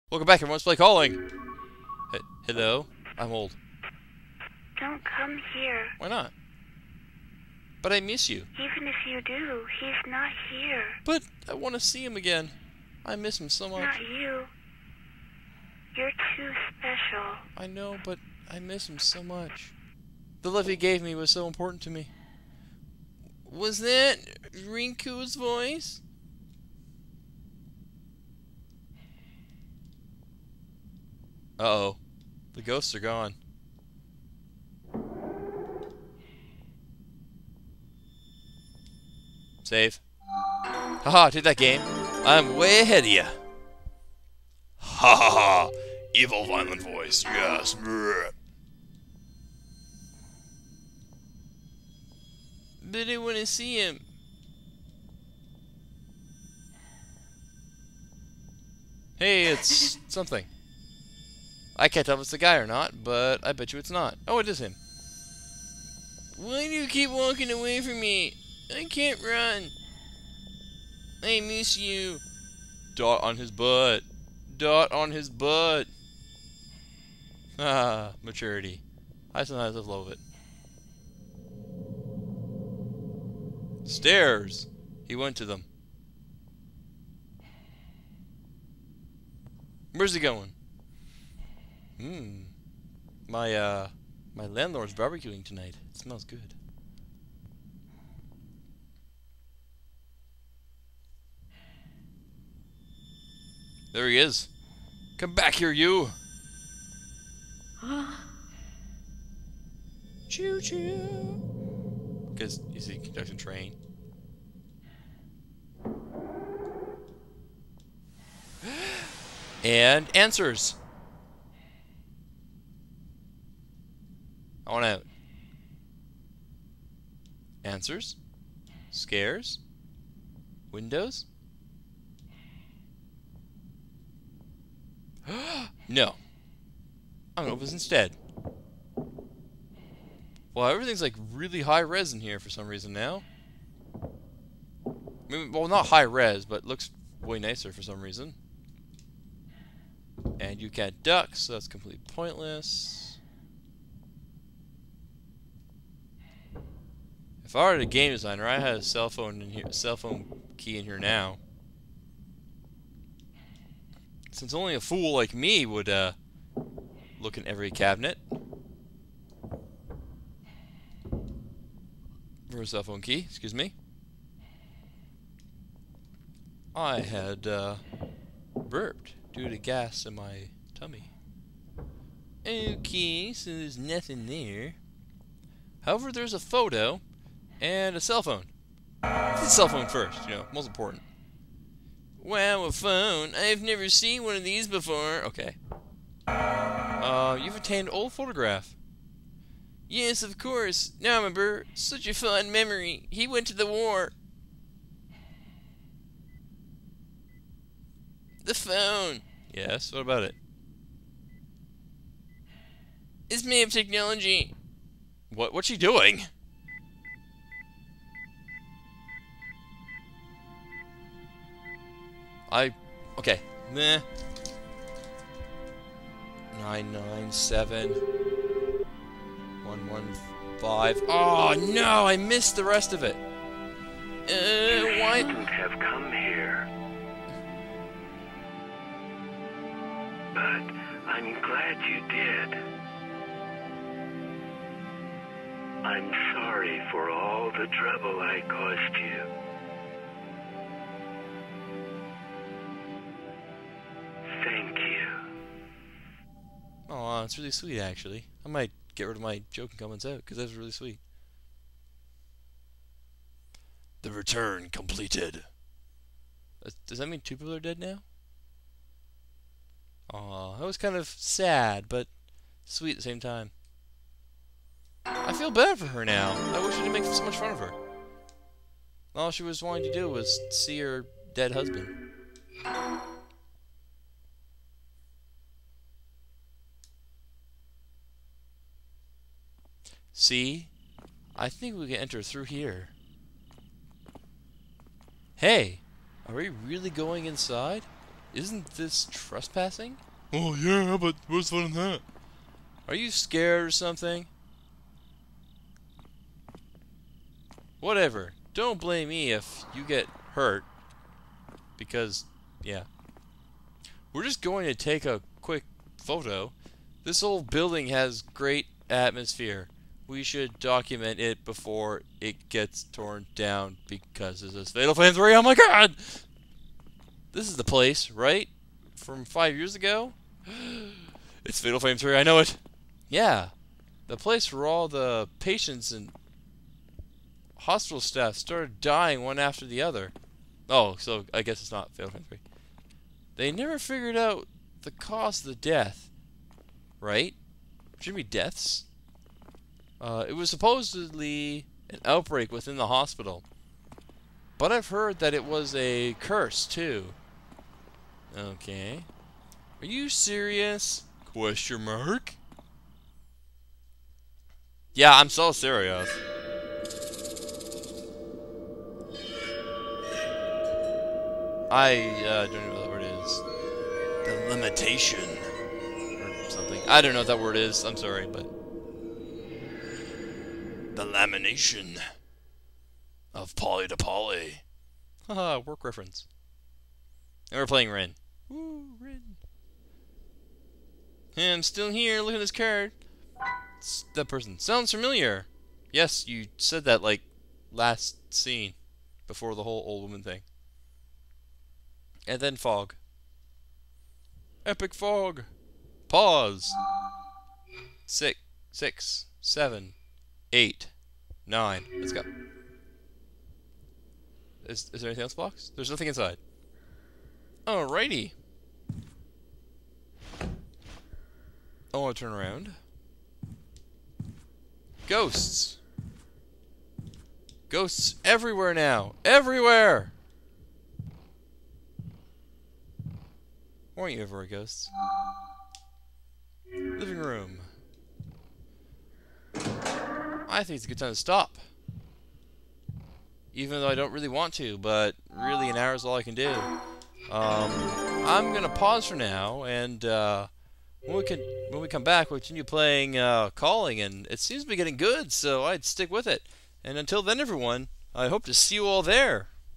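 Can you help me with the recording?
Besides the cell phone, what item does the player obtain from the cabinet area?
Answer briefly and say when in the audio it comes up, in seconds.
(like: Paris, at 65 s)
Old photograph, at 197 s.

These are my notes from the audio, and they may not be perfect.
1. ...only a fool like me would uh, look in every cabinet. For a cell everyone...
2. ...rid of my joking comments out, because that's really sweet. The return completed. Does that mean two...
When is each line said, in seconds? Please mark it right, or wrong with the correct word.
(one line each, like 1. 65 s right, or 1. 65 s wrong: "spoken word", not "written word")
1. 164 s wrong: "phone", not "everyone"
2. 259 s right.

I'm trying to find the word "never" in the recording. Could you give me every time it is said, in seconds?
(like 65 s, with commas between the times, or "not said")
193 s, 343 s.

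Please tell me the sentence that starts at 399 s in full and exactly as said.
Before the whole old woman thing.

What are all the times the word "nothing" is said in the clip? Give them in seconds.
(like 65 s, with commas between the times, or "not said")
183 s, 415 s.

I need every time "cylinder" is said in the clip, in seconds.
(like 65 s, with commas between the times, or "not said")
not said.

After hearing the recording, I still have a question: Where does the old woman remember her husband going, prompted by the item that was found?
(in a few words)
The war.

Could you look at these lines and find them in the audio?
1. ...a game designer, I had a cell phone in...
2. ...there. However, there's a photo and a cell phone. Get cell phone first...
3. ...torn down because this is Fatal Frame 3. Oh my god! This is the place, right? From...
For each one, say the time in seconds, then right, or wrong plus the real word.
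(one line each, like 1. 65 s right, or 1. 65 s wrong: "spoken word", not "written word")
1. 157 s right
2. 184 s right
3. 322 s right.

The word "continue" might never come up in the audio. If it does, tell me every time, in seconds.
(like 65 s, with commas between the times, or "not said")
452 s.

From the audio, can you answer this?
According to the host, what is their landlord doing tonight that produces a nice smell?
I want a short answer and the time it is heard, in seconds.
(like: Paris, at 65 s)
Barbecuing, at 94 s.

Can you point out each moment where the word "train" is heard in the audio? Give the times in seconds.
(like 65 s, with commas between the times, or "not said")
113 s.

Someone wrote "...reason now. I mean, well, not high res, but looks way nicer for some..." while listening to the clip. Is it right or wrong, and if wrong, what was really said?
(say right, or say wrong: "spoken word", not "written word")
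right.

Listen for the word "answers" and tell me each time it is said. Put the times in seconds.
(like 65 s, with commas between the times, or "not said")
120 s, 127 s.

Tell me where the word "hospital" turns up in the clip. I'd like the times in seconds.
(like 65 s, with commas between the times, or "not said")
337 s, 352 s.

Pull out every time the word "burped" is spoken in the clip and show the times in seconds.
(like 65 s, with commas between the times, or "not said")
178 s.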